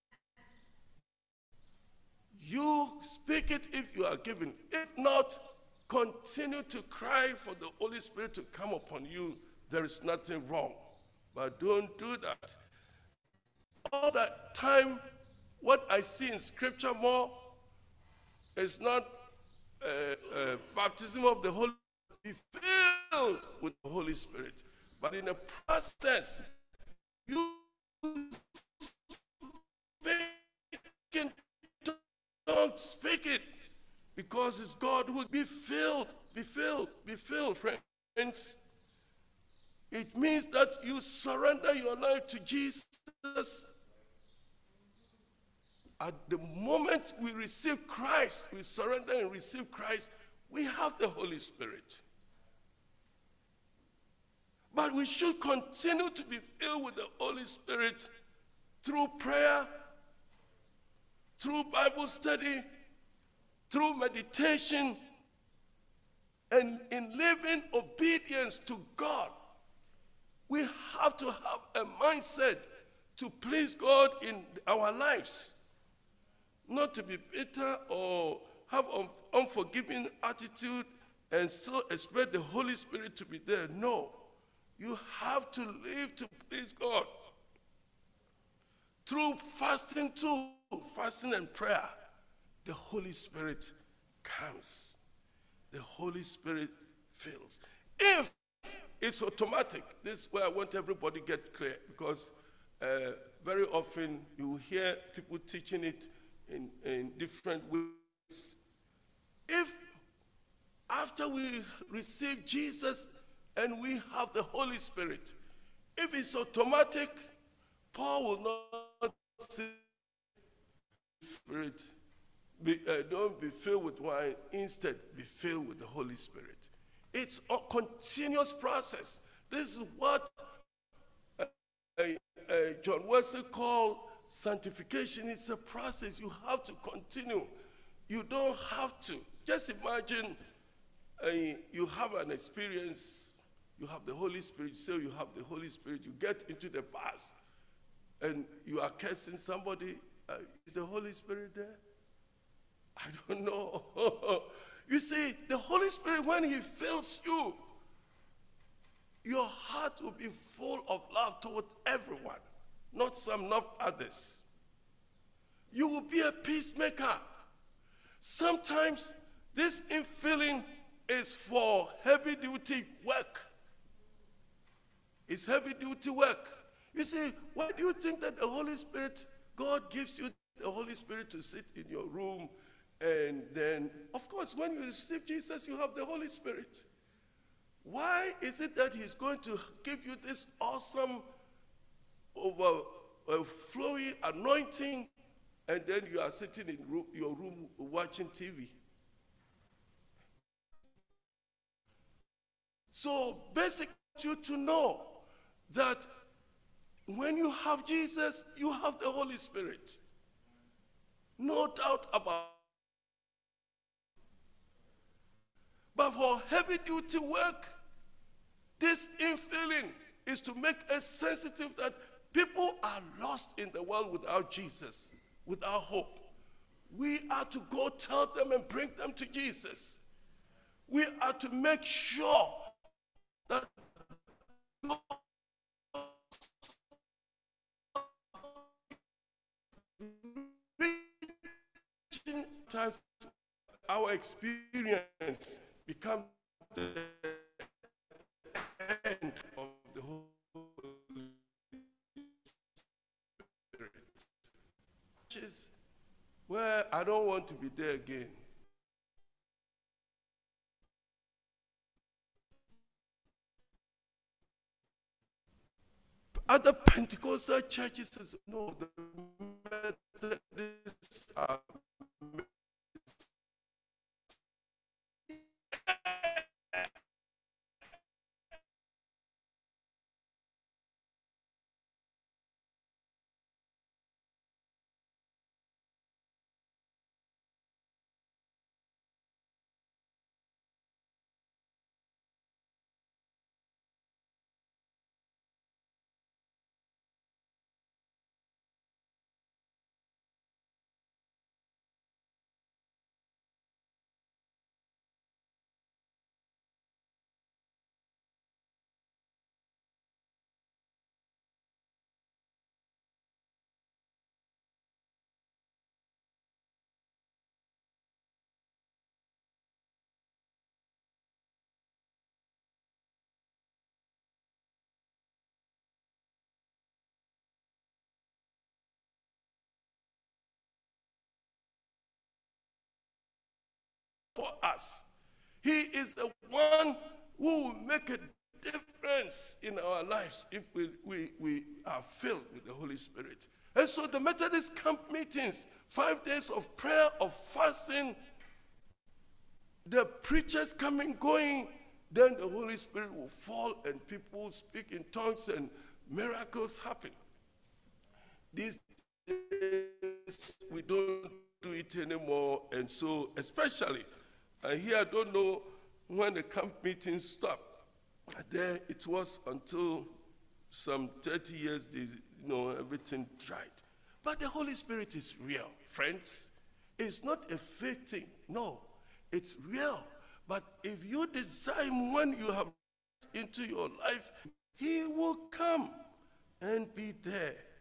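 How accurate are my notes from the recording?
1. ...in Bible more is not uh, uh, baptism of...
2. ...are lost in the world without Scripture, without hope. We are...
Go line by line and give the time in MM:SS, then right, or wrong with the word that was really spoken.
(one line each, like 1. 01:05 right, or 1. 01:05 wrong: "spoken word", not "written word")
1. 00:16 wrong: "Scripture", not "Bible"
2. 03:42 wrong: "Jesus", not "Scripture".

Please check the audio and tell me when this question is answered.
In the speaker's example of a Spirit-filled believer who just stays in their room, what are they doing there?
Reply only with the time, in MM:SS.
03:17.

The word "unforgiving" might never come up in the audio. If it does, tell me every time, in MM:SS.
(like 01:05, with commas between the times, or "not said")
01:19.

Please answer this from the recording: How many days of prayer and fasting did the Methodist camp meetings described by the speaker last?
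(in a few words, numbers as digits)
5.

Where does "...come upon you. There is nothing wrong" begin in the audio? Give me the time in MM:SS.
00:08.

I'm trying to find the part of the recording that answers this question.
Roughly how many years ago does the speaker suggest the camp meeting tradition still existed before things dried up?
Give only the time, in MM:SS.
06:11.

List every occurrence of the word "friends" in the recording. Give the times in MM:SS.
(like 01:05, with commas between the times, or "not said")
00:37, 06:15.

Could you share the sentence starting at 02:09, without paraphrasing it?
This is what uh, uh, John Wesley called sanctification.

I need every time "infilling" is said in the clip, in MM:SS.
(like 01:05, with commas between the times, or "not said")
02:49, 03:39.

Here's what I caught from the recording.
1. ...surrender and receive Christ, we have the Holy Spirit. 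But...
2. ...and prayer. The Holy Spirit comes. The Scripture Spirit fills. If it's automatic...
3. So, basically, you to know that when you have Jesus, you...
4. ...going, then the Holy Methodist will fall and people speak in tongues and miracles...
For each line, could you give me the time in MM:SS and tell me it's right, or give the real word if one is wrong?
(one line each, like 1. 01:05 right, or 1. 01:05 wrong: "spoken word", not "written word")
1. 00:48 right
2. 01:31 wrong: "Holy", not "Scripture"
3. 03:22 right
4. 05:51 wrong: "Spirit", not "Methodist".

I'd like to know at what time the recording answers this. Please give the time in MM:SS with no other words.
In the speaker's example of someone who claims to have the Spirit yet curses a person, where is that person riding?
02:26.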